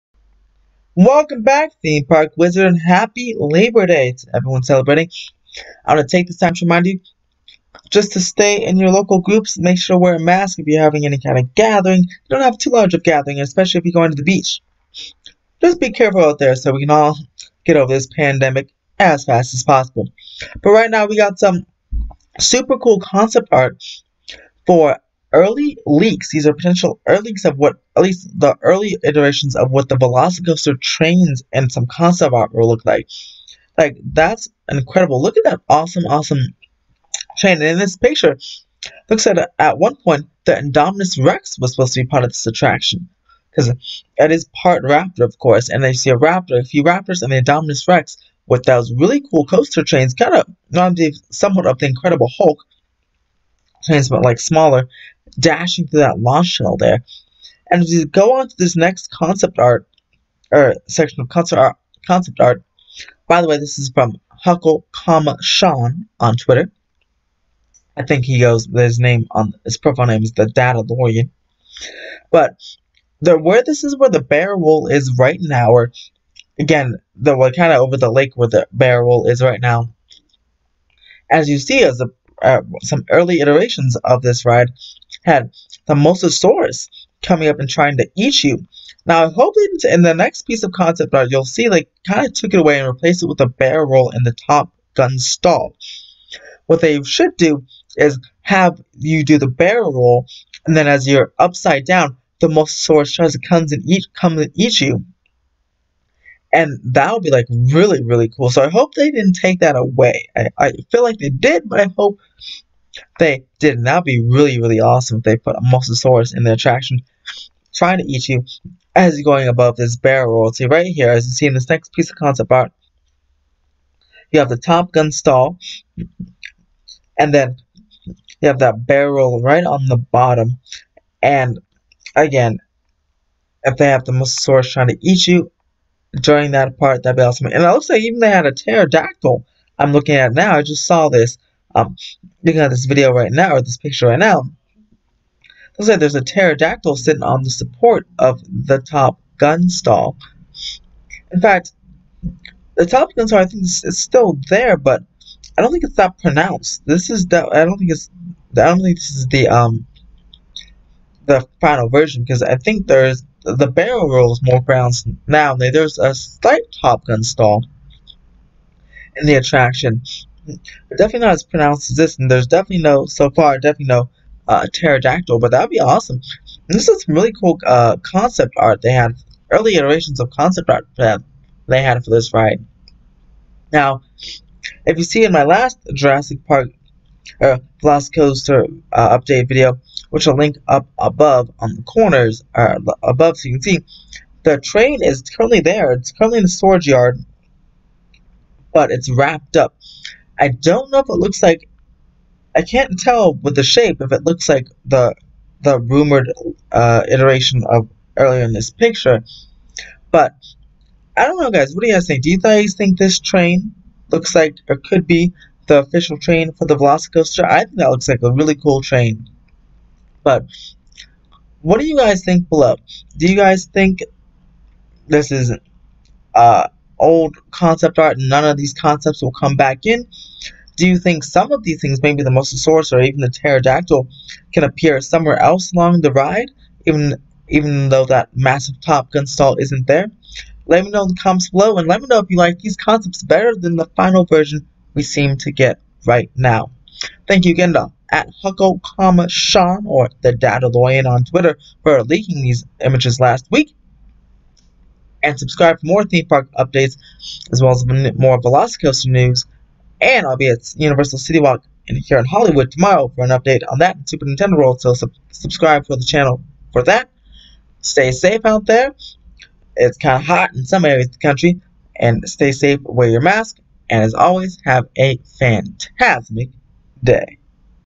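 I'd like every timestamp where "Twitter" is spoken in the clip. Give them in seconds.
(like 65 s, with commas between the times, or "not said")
66 s, 251 s.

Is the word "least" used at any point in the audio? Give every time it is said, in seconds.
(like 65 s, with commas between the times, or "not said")
28 s.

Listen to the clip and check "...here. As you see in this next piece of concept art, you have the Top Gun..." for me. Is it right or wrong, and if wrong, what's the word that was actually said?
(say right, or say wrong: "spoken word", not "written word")
right.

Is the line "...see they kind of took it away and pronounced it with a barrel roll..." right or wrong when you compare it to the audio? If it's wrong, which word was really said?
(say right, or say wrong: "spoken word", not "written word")
wrong: "replaced", not "pronounced".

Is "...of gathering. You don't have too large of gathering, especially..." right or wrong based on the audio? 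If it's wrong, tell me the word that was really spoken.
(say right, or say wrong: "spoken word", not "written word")
right.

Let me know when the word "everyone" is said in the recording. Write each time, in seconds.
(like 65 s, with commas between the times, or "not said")
4 s.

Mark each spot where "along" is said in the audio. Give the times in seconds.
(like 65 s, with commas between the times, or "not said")
235 s.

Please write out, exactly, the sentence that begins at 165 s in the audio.
There's a slight Top Gun stall in the attraction.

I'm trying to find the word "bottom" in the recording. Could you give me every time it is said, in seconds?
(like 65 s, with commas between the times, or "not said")
129 s.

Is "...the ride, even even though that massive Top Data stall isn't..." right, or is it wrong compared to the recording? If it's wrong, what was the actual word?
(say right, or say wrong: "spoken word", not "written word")
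wrong: "Gun", not "Data".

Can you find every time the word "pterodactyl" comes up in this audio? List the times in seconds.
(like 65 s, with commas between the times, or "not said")
138 s, 146 s, 174 s, 233 s.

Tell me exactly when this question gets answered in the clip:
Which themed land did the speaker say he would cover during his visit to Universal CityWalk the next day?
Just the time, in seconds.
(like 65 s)
264 s.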